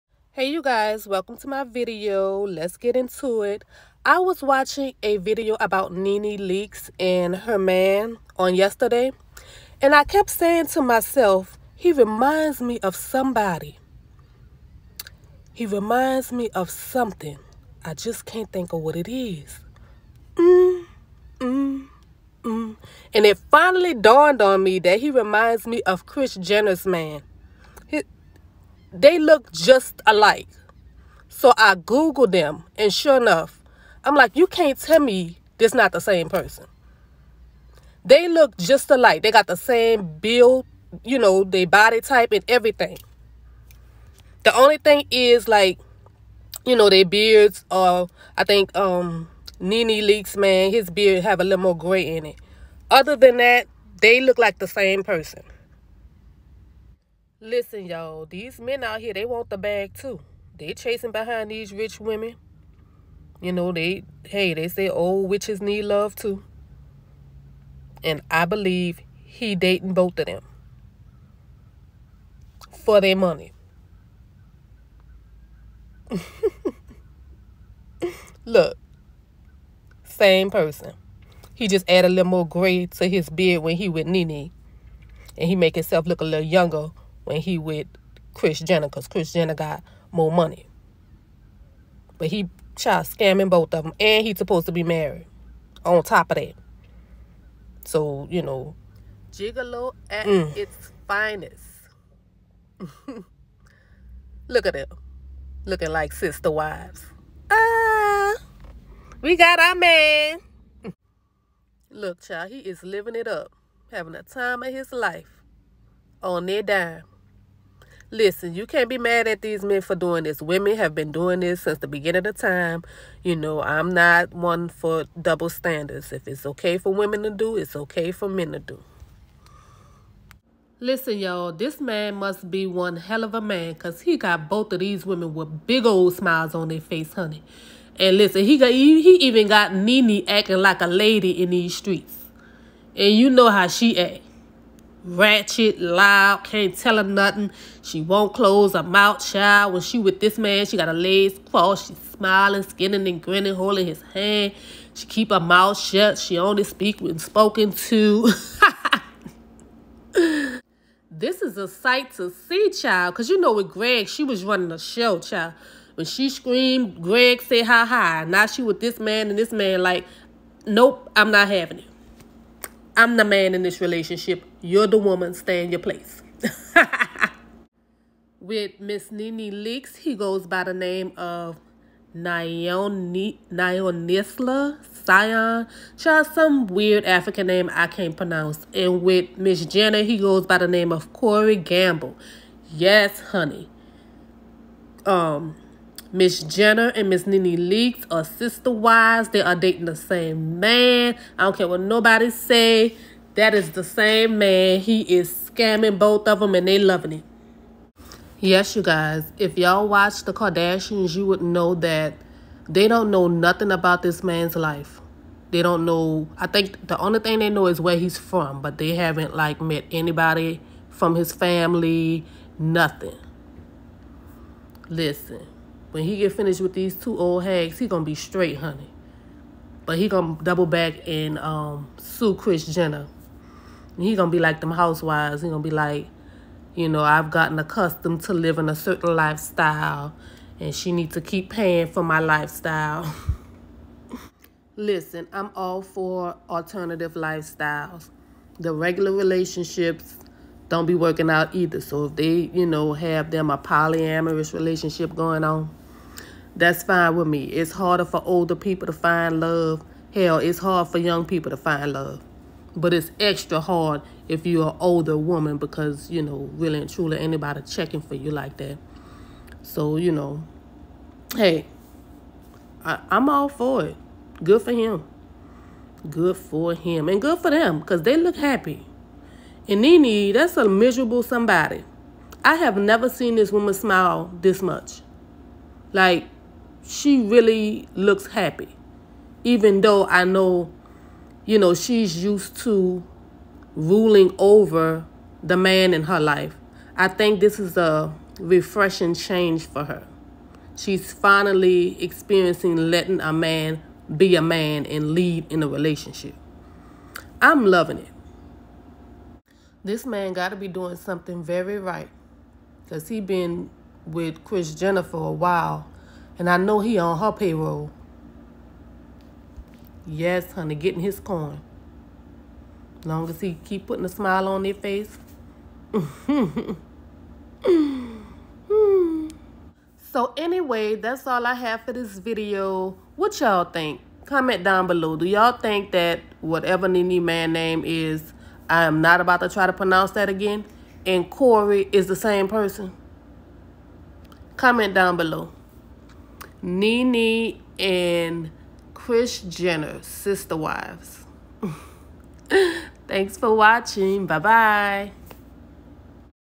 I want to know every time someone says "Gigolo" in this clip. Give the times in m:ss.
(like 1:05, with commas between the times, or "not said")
1:39.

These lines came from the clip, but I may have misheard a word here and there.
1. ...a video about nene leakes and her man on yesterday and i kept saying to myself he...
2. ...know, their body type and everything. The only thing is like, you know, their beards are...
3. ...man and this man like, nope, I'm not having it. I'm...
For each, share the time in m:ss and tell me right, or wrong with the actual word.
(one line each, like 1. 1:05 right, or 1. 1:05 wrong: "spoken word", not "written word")
1. 0:05 right
2. 0:41 right
3. 2:48 right.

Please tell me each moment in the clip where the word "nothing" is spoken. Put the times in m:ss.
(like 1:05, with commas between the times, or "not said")
2:27, 3:33, 3:42.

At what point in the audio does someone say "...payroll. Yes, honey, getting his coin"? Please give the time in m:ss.
5:17.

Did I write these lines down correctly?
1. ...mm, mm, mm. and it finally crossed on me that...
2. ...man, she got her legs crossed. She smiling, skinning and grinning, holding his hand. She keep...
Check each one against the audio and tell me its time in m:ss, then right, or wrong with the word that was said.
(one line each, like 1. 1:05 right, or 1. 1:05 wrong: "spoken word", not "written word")
1. 0:20 wrong: "dawned", not "crossed"
2. 2:30 right.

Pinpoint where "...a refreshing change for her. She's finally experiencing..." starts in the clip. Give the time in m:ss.
4:57.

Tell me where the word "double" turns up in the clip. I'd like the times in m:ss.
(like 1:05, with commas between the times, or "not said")
2:05, 3:50.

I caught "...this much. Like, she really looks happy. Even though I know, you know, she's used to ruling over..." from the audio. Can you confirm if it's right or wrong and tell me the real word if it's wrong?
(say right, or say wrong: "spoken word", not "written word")
right.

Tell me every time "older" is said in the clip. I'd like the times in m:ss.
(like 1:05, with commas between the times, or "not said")
4:18, 4:24.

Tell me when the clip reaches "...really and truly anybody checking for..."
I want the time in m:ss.
4:26.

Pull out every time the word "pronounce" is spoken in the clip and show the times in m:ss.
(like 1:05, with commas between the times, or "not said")
3:08, 5:39.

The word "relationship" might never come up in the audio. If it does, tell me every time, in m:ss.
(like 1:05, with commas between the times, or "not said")
2:53, 4:09, 4:14, 5:05.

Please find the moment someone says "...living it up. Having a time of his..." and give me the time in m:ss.
1:52.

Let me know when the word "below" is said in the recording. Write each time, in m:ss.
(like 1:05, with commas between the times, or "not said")
5:34, 5:45.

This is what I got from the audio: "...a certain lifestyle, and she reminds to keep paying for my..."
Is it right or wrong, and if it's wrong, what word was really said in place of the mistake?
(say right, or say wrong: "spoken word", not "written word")
wrong: "needs", not "reminds".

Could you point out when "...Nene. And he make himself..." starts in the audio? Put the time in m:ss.
1:24.